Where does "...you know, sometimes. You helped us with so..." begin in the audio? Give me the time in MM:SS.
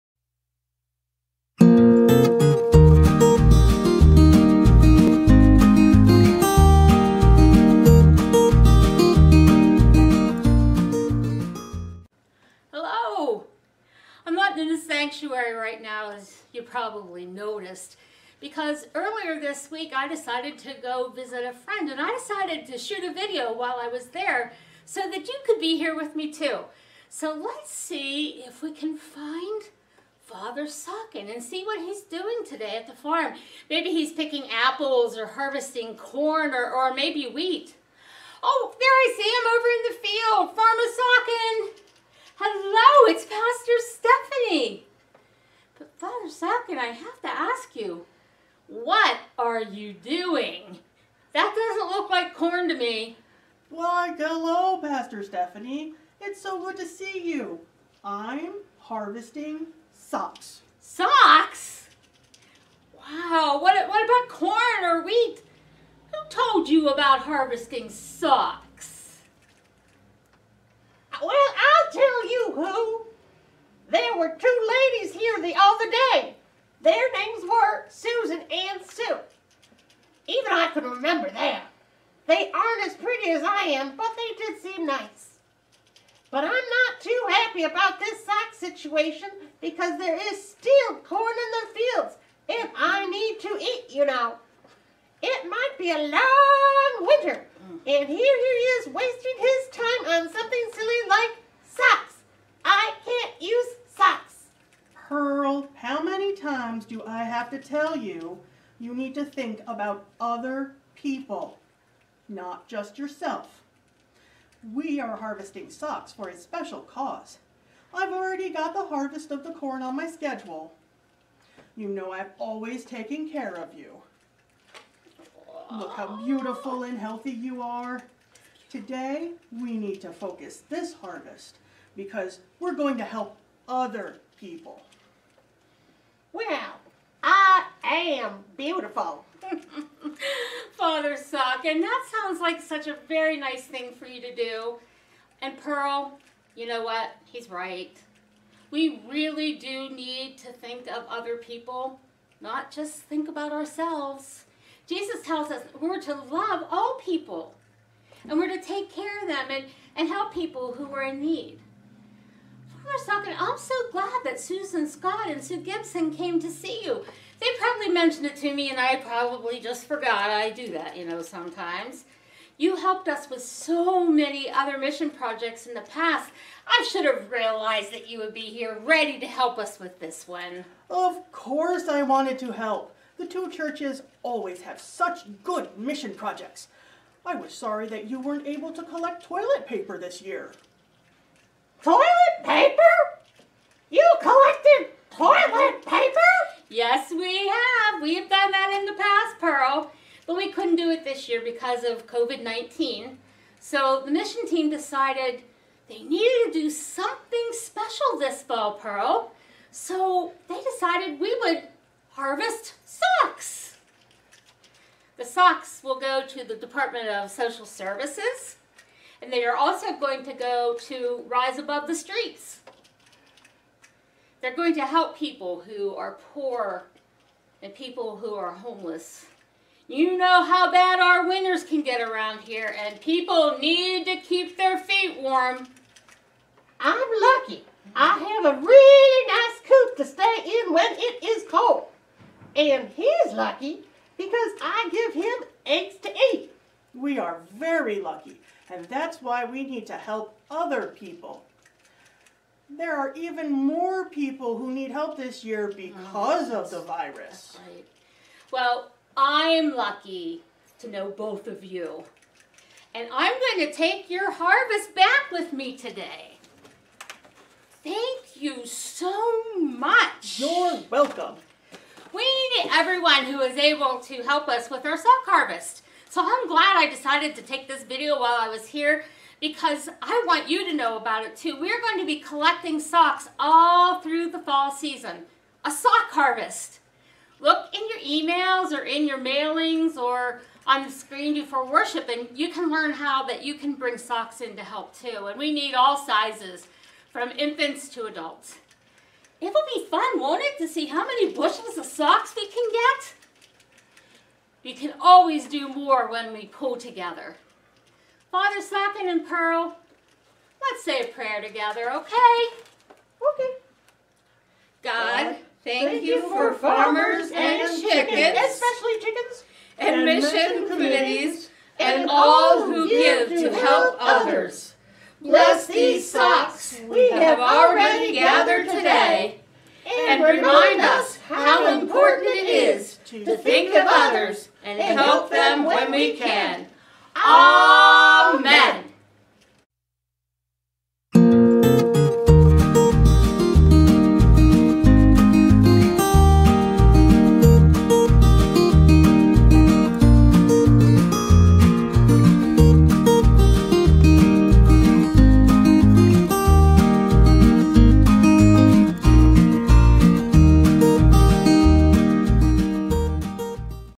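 02:50.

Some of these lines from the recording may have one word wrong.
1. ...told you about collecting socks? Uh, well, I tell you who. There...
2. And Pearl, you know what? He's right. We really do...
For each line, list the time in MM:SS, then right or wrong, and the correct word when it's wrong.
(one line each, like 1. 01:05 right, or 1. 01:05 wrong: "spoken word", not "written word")
1. 01:06 wrong: "harvesting", not "collecting"
2. 02:25 right.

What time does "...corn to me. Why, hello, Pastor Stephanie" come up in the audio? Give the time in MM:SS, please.
00:52.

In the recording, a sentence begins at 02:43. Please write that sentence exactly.
Father Sock, I'm so glad that Susan Scott and Sue Gibson came to see you.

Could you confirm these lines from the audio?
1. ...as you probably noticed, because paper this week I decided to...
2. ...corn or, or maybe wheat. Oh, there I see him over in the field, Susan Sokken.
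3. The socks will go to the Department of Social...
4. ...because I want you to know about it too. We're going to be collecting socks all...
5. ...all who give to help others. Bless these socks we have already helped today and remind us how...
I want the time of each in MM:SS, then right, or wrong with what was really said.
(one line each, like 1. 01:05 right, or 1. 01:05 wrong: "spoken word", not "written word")
1. 00:16 wrong: "earlier", not "paper"
2. 00:35 wrong: "Farmer", not "Susan"
3. 03:35 right
4. 04:39 right
5. 05:22 wrong: "gathered", not "helped".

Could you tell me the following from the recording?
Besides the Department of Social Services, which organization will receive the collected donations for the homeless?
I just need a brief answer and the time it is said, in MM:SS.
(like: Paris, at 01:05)
Rise Above the Streets, at 03:41.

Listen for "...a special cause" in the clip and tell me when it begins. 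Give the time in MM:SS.
01:56.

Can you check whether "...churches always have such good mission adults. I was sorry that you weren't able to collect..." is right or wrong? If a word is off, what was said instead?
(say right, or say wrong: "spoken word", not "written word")
wrong: "projects", not "adults".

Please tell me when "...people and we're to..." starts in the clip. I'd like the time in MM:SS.
02:37.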